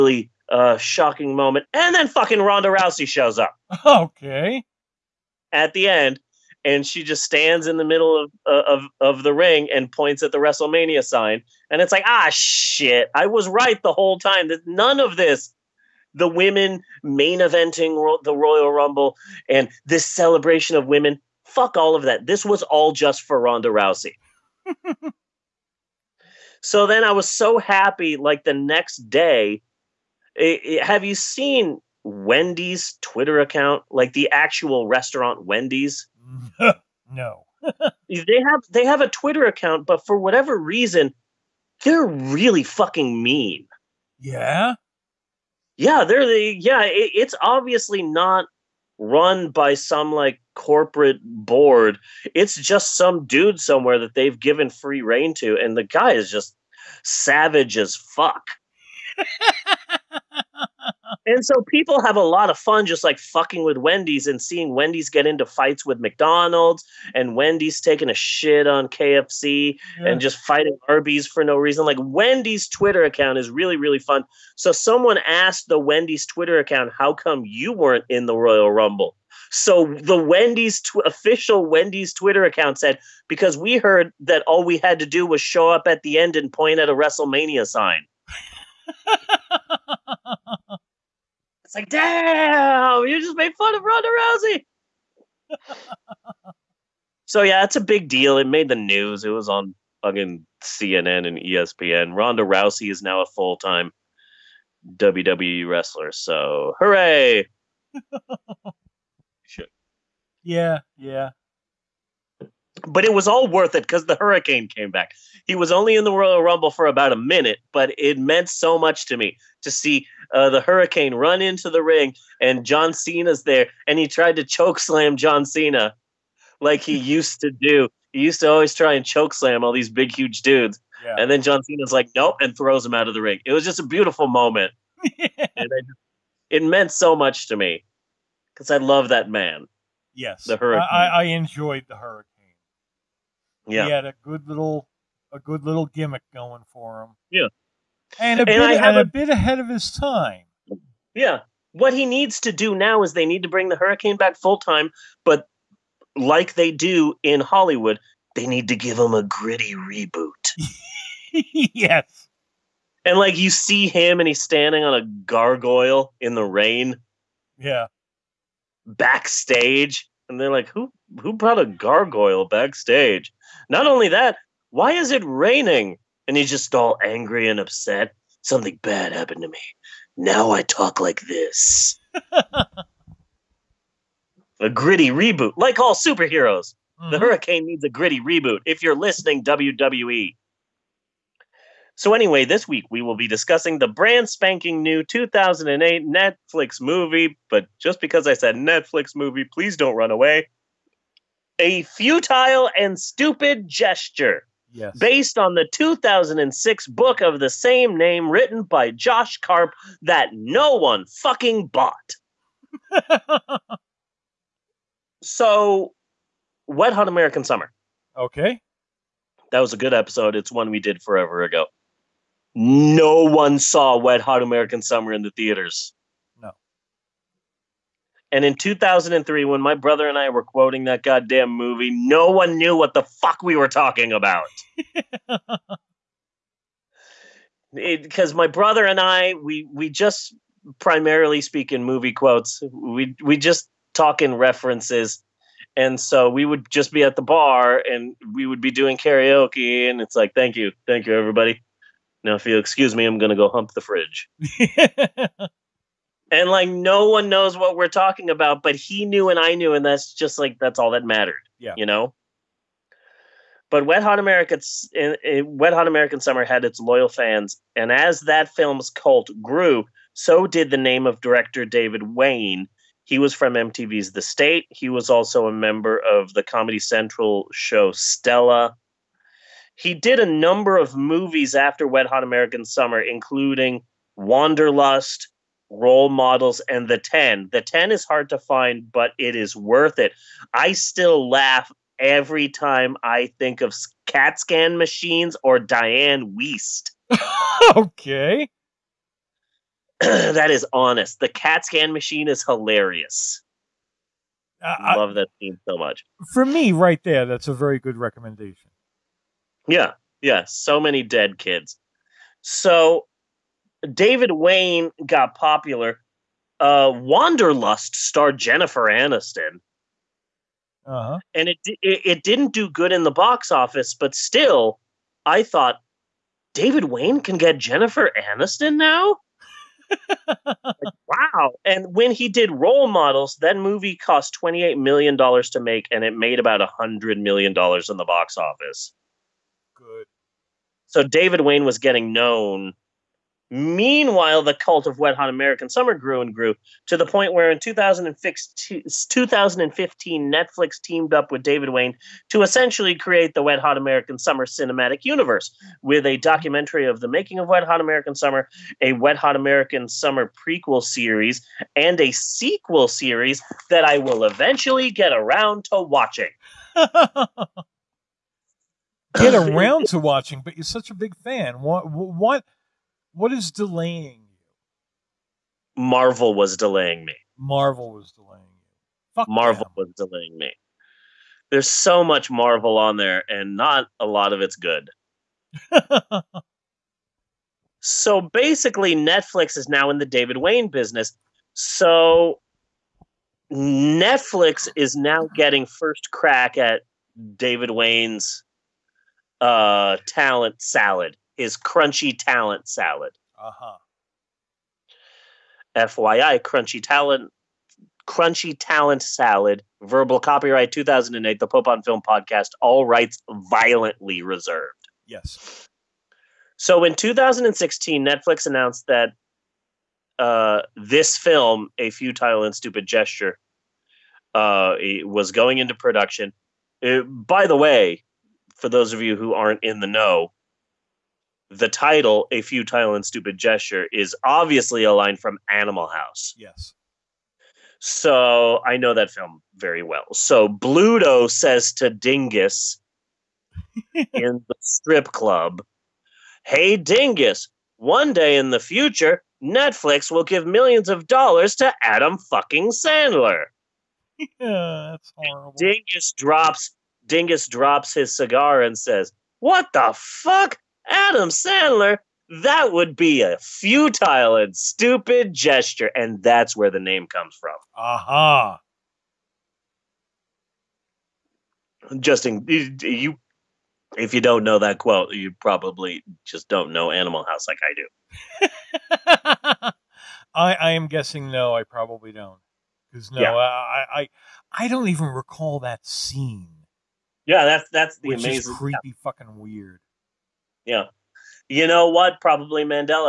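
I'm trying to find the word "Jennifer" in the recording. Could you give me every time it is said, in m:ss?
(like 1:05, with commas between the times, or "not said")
5:18, 5:27.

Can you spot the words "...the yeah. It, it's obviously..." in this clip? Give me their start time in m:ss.
0:46.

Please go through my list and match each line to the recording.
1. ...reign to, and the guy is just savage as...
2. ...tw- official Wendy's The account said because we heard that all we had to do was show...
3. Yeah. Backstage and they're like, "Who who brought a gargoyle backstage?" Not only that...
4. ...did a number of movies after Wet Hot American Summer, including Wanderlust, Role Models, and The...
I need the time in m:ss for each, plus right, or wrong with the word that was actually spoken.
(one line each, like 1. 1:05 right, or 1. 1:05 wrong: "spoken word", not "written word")
1. 0:55 right
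2. 1:20 wrong: "Twitter", not "The"
3. 2:47 right
4. 4:39 right.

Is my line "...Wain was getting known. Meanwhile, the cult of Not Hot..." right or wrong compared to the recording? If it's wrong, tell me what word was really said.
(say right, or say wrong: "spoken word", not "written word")
wrong: "Wet", not "Not".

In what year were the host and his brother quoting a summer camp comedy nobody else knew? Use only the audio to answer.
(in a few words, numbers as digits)
2003.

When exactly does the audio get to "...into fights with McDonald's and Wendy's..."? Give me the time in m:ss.
1:05.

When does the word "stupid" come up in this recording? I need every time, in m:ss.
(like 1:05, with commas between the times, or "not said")
3:22, 7:02, 7:13, 7:44.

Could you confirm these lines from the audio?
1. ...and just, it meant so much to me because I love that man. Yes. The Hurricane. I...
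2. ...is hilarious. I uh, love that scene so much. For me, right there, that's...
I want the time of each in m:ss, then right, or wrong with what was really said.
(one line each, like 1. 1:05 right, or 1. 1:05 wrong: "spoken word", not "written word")
1. 2:15 right
2. 5:02 right.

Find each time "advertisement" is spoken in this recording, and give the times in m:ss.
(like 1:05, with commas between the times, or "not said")
not said.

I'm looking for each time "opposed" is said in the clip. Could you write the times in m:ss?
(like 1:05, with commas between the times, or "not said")
not said.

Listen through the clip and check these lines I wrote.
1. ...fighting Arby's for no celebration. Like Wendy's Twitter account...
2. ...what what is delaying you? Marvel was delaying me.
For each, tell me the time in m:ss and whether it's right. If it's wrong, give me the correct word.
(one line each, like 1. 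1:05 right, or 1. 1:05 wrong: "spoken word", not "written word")
1. 1:10 wrong: "reason", not "celebration"
2. 6:11 right.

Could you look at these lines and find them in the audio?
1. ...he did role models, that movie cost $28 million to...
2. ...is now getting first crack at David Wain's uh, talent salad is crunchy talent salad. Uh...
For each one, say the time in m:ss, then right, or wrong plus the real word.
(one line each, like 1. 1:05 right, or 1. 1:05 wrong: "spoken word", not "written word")
1. 5:32 right
2. 6:34 right.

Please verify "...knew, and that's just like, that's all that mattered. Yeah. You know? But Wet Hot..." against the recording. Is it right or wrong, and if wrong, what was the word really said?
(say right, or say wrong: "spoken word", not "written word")
right.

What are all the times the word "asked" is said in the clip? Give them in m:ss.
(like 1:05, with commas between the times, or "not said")
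1:15.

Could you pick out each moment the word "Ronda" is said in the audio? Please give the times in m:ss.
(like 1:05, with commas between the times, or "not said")
0:02, 0:23, 1:33, 1:42.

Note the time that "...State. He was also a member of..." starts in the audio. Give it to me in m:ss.
4:34.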